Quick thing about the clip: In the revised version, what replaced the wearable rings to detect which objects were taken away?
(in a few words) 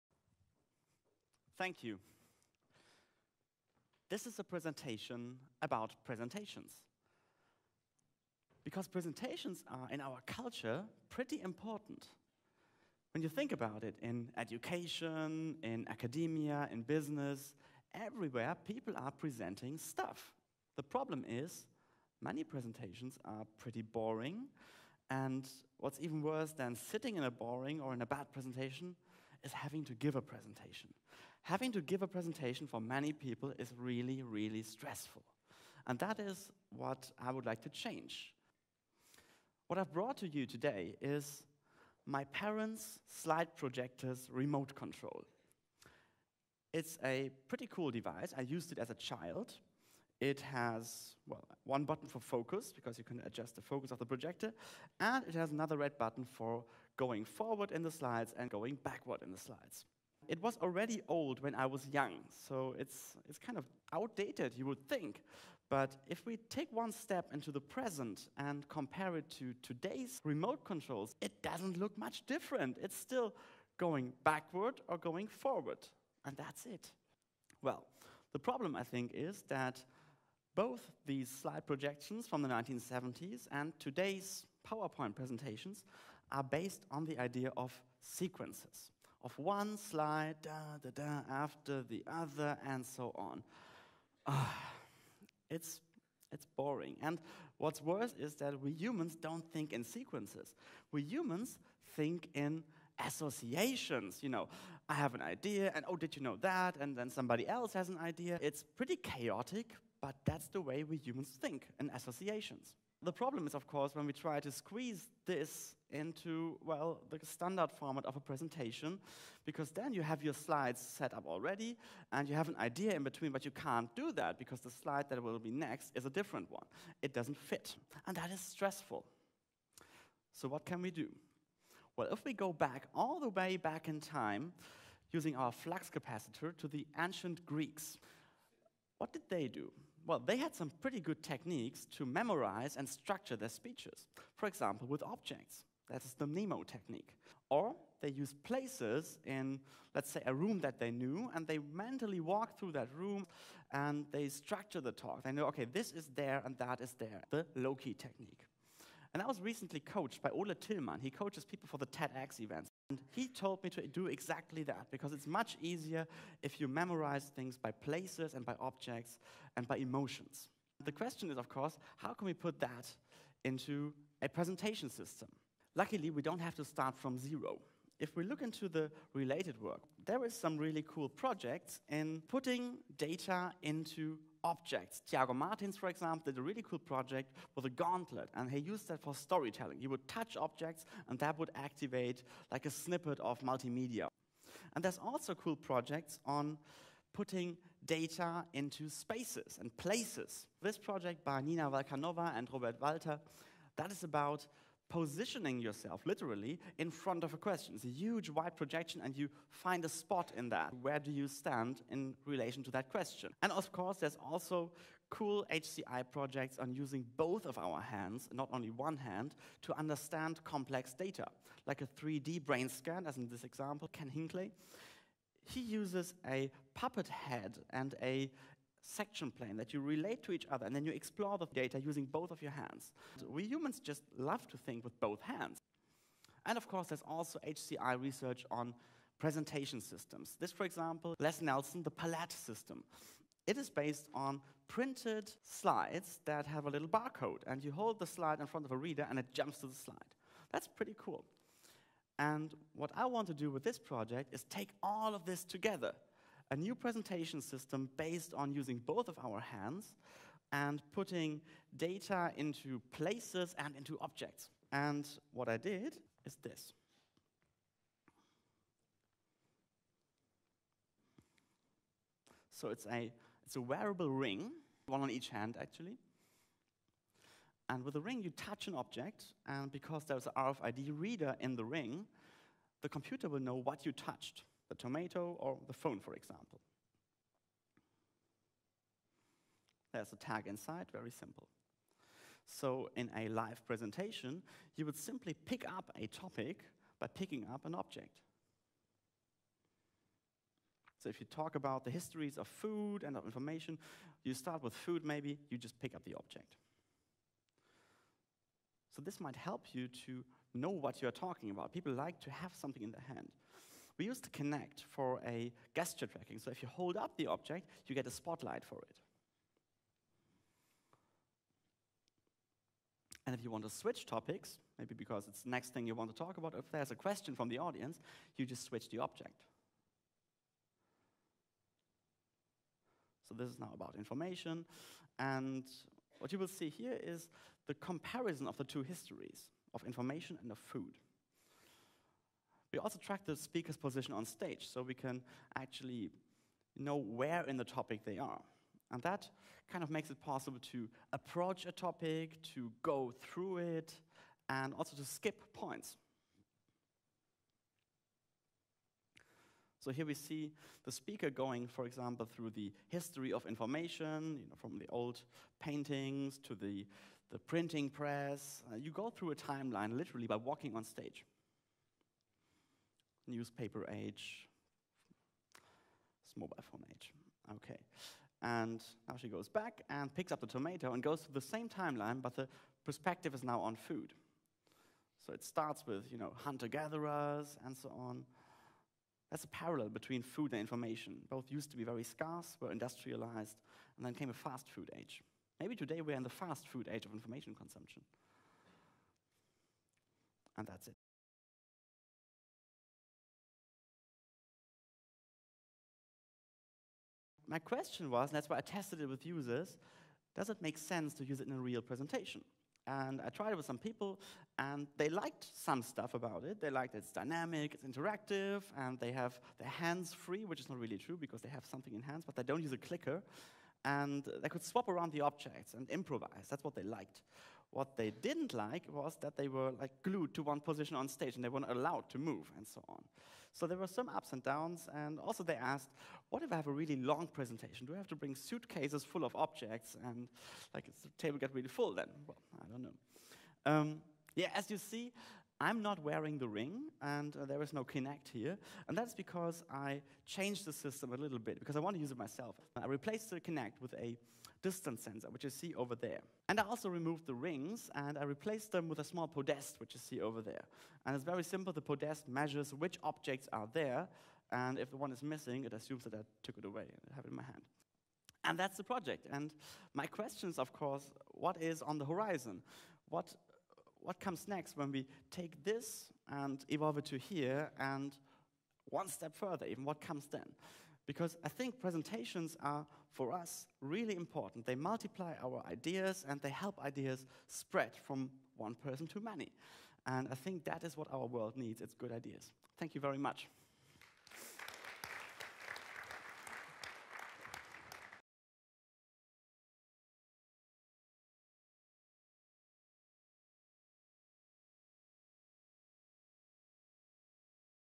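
A small podest.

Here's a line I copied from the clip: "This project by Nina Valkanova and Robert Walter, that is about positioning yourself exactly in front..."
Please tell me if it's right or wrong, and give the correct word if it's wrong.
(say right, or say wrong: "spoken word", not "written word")
wrong: "literally", not "exactly".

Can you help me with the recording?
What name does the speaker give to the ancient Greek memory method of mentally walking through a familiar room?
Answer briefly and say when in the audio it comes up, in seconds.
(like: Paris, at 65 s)
Loci technique, at 157 s.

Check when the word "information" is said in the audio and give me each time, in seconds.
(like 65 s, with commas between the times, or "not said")
303 s, 333 s, 339 s, 363 s, 390 s, 397 s.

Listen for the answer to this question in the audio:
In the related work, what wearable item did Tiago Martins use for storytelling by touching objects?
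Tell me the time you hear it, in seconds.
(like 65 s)
187 s.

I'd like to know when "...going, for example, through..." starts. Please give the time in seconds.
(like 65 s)
361 s.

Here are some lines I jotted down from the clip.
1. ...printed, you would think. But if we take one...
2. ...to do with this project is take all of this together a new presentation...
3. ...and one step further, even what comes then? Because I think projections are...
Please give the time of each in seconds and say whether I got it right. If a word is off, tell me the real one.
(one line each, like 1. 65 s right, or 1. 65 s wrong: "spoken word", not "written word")
1. 63 s wrong: "outdated", not "printed"
2. 253 s right
3. 477 s wrong: "presentations", not "projections".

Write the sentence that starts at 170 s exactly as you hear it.
The question is, of course, how can we put that into a presentation system?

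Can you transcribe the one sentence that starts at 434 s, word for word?
And also they asked, what if I have a really long presentation?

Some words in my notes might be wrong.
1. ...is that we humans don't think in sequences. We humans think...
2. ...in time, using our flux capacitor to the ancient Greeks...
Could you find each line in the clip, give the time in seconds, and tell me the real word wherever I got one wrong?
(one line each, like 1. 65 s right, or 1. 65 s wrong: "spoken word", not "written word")
1. 98 s right
2. 133 s right.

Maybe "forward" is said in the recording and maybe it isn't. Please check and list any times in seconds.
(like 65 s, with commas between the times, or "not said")
57 s, 75 s.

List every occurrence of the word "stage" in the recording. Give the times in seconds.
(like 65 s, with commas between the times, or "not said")
344 s, 370 s, 431 s.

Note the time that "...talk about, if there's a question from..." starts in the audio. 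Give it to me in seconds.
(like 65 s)
326 s.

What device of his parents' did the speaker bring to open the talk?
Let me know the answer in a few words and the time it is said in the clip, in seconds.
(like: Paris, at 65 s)
Slide projector remote control, at 43 s.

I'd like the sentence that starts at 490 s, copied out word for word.
And I think that is what our world needs it's good ideas.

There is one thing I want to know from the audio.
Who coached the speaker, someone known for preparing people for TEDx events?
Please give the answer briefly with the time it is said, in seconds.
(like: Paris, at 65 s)
Ole Tillman, at 160 s.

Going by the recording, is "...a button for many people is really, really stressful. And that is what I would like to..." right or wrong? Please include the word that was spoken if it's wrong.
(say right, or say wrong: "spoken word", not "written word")
wrong: "presentation", not "button".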